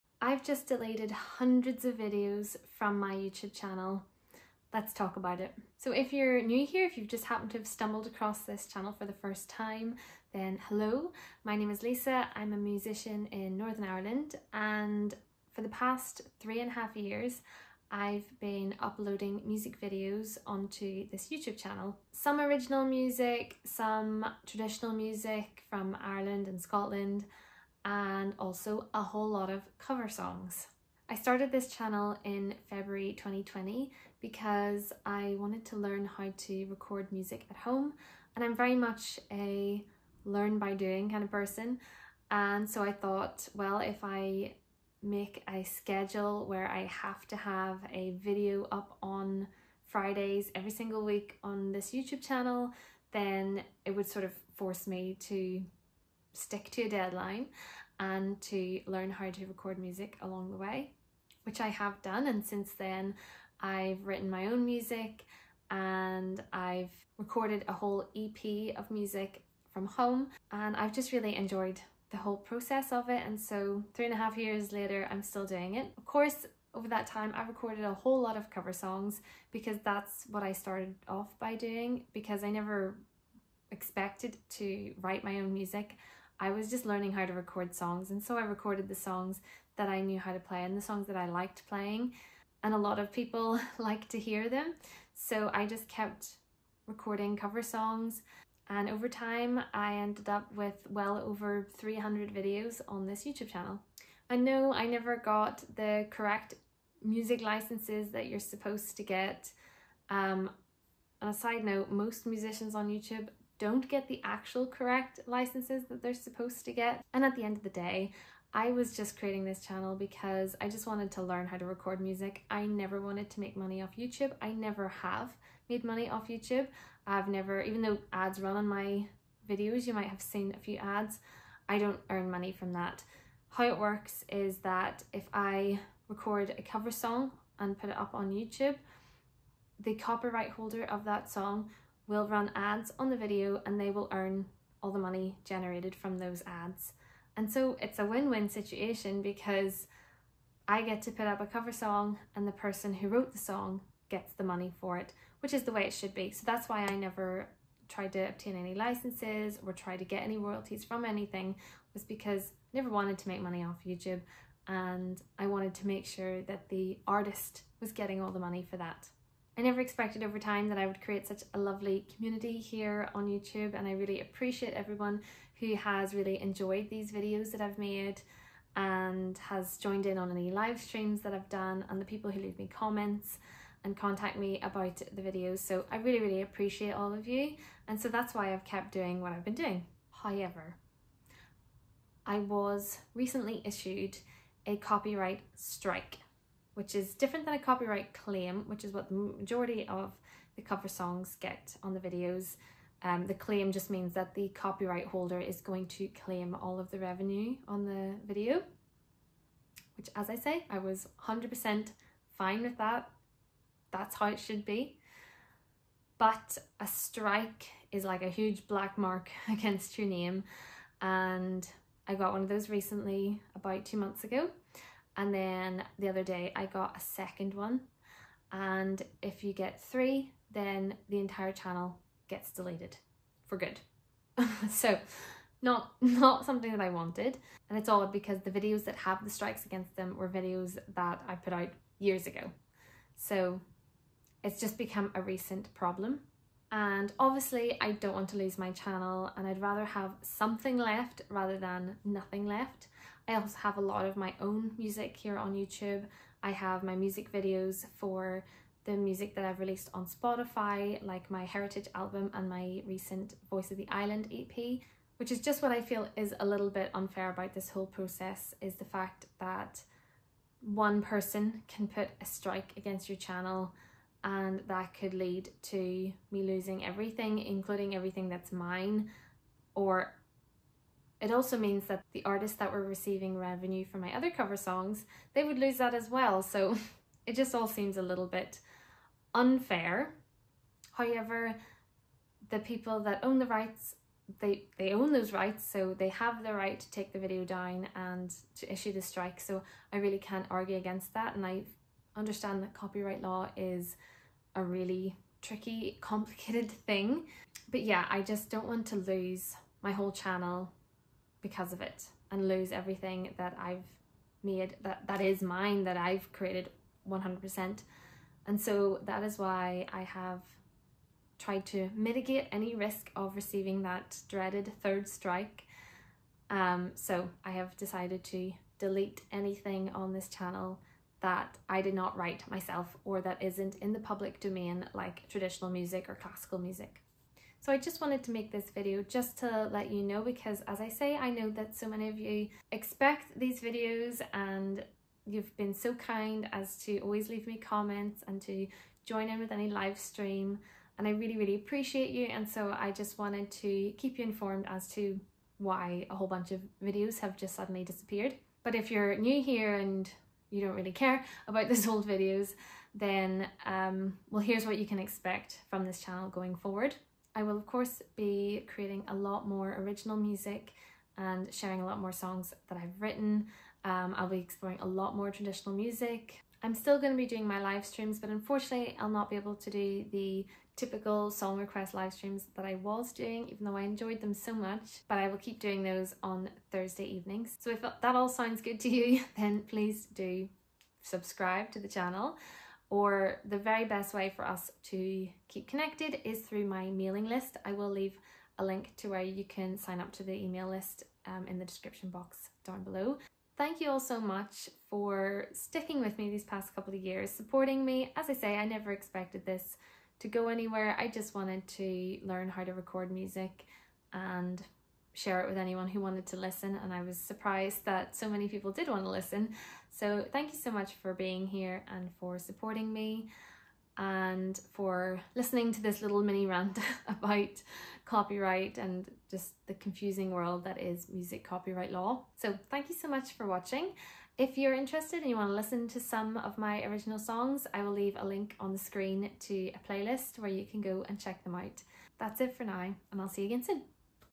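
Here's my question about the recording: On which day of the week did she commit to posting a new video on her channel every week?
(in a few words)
Fridays.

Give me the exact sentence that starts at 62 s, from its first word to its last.
And since then, I've written my own music and I've recorded a whole EP of music from home.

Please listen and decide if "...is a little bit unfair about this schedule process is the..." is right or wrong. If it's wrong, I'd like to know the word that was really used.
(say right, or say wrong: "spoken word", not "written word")
wrong: "whole", not "schedule".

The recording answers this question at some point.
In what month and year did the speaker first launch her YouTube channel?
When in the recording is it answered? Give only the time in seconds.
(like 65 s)
32 s.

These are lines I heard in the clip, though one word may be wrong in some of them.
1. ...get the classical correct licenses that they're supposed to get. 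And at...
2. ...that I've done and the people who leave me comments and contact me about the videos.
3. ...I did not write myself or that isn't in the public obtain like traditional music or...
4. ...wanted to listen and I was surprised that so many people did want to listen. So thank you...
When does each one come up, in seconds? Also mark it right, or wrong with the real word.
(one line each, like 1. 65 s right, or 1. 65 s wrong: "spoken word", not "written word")
1. 113 s wrong: "actual", not "classical"
2. 181 s right
3. 331 s wrong: "domain", not "obtain"
4. 415 s right.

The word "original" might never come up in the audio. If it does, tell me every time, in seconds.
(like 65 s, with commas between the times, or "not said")
22 s, 369 s, 436 s.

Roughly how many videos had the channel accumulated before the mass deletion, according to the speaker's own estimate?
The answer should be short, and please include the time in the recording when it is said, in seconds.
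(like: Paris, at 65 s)
over 300, at 100 s.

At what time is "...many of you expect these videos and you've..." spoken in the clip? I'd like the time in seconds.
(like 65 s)
341 s.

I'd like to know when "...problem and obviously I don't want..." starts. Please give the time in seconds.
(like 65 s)
245 s.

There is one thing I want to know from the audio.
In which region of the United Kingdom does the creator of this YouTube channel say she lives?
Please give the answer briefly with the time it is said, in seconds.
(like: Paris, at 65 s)
Northern Ireland, at 13 s.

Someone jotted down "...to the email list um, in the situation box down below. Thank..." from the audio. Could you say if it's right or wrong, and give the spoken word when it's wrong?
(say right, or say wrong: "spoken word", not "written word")
wrong: "description", not "situation".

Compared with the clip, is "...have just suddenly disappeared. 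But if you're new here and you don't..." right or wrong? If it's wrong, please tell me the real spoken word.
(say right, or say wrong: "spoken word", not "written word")
right.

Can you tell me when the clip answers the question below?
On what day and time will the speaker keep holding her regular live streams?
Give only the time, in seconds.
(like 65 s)
386 s.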